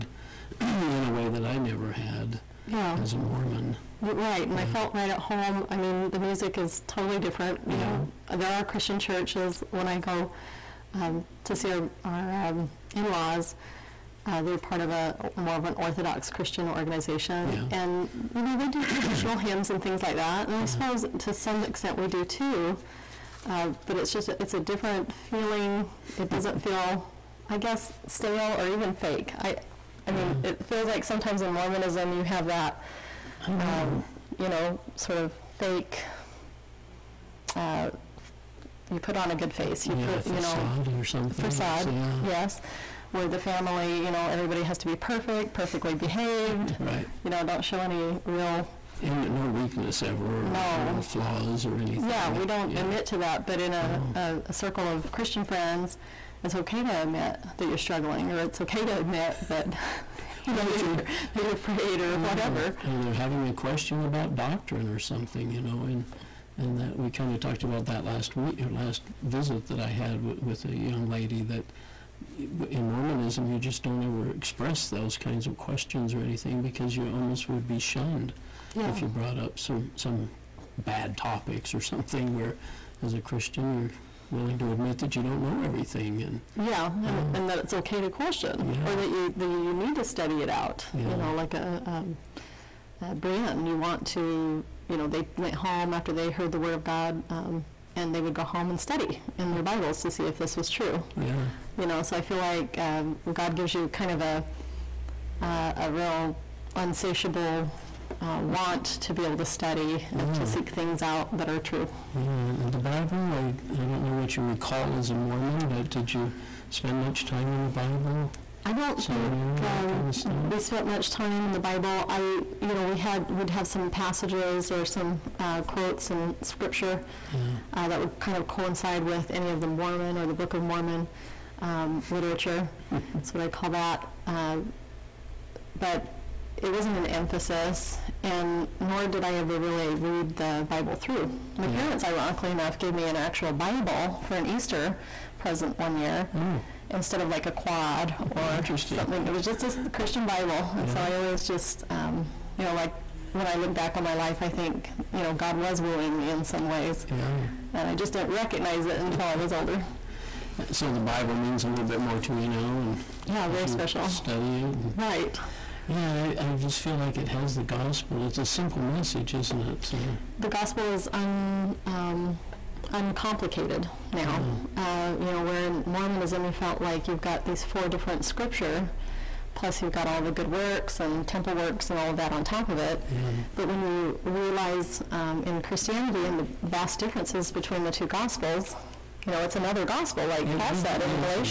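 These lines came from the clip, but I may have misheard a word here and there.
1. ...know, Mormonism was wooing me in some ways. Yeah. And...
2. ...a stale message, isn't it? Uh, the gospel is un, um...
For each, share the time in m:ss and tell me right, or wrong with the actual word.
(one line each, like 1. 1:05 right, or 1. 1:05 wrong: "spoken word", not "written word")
1. 2:35 wrong: "God", not "Mormonism"
2. 2:48 wrong: "simple", not "stale".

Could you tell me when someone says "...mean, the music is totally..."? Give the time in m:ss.
0:05.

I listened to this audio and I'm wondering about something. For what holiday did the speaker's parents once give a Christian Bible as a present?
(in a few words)
Easter.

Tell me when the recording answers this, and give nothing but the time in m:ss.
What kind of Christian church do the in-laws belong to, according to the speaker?
0:15.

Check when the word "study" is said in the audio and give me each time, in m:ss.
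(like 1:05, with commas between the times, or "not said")
1:30, 1:38, 1:49, 2:44.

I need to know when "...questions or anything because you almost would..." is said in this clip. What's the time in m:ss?
1:15.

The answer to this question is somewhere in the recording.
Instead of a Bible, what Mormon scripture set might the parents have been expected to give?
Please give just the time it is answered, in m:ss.
2:27.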